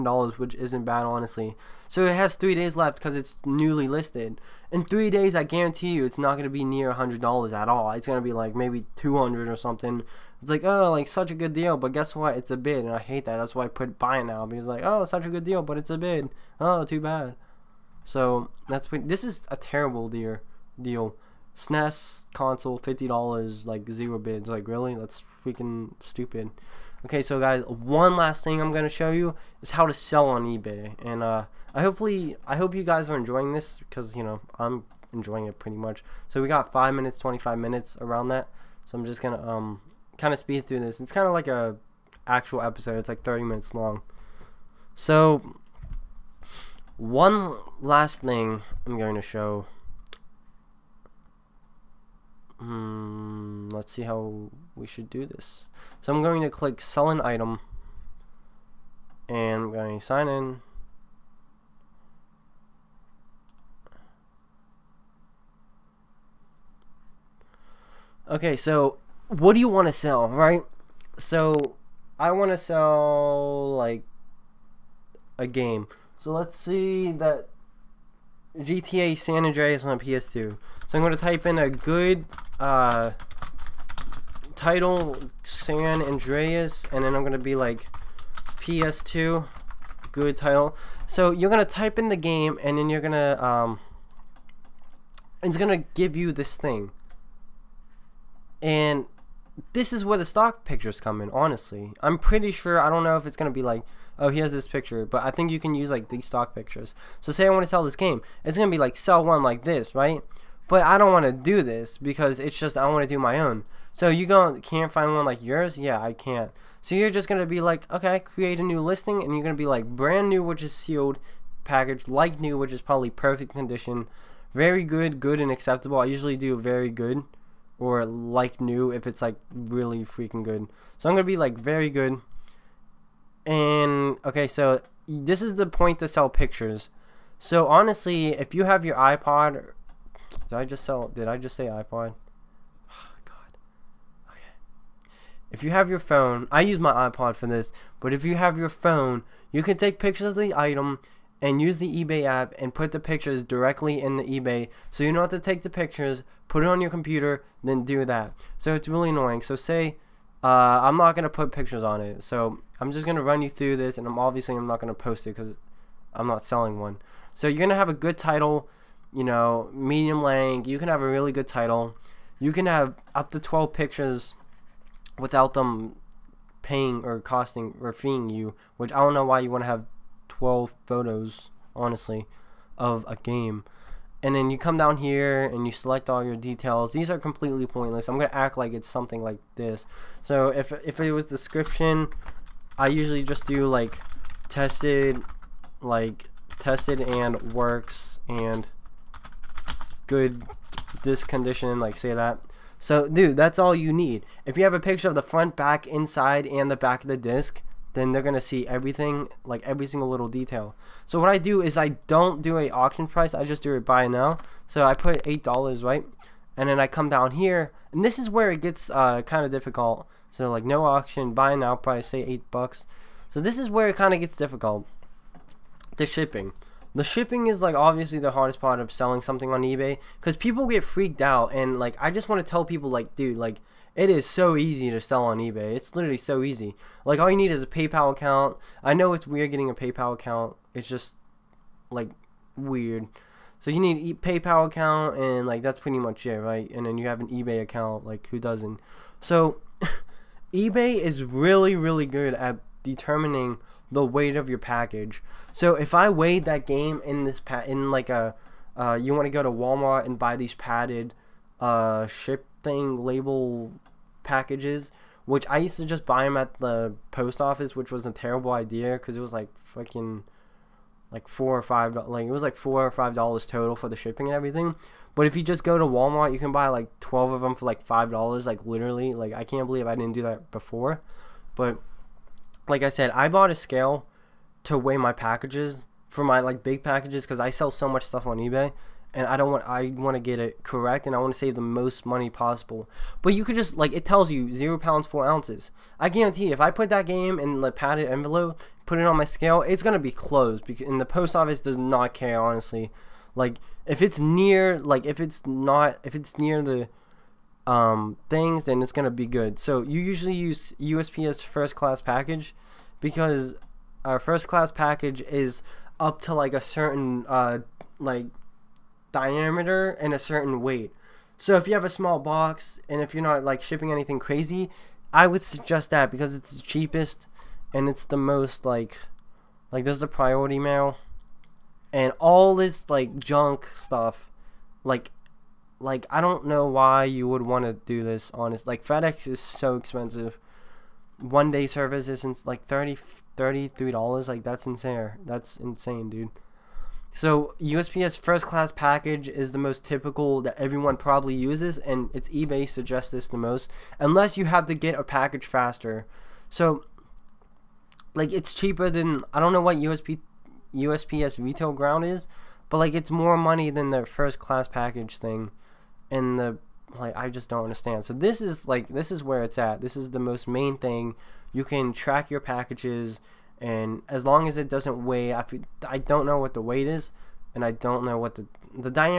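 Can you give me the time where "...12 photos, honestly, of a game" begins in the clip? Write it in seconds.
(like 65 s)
180 s.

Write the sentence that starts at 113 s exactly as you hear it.
So you go can't find one like yours?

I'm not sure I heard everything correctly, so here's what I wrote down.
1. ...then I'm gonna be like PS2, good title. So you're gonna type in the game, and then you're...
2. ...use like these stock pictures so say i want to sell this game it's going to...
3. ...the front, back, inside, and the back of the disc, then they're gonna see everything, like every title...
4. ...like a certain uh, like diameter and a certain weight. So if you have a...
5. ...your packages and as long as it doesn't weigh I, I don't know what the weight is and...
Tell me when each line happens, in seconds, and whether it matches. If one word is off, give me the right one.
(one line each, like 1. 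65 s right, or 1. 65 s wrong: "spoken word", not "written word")
1. 87 s right
2. 105 s right
3. 205 s wrong: "single", not "title"
4. 316 s right
5. 372 s right.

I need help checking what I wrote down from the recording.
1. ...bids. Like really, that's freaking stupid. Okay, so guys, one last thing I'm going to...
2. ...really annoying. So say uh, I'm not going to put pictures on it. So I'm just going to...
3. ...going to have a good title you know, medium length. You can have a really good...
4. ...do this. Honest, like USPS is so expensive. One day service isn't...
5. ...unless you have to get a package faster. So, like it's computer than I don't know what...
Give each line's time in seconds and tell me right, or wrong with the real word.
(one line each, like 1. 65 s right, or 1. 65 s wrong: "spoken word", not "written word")
1. 24 s right
2. 158 s right
3. 167 s right
4. 337 s wrong: "FedEx", not "USPS"
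5. 353 s wrong: "cheaper", not "computer".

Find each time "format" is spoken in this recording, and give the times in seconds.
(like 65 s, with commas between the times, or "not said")
not said.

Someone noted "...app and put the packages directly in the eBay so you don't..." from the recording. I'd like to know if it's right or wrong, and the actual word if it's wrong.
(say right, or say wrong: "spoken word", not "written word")
wrong: "pictures", not "packages".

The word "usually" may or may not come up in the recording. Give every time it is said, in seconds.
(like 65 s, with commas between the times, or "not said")
126 s, 192 s, 310 s.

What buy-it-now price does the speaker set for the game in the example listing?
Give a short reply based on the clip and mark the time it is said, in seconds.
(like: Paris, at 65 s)
$8, at 215 s.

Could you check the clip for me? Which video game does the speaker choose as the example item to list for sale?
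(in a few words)
GTA San Andreas.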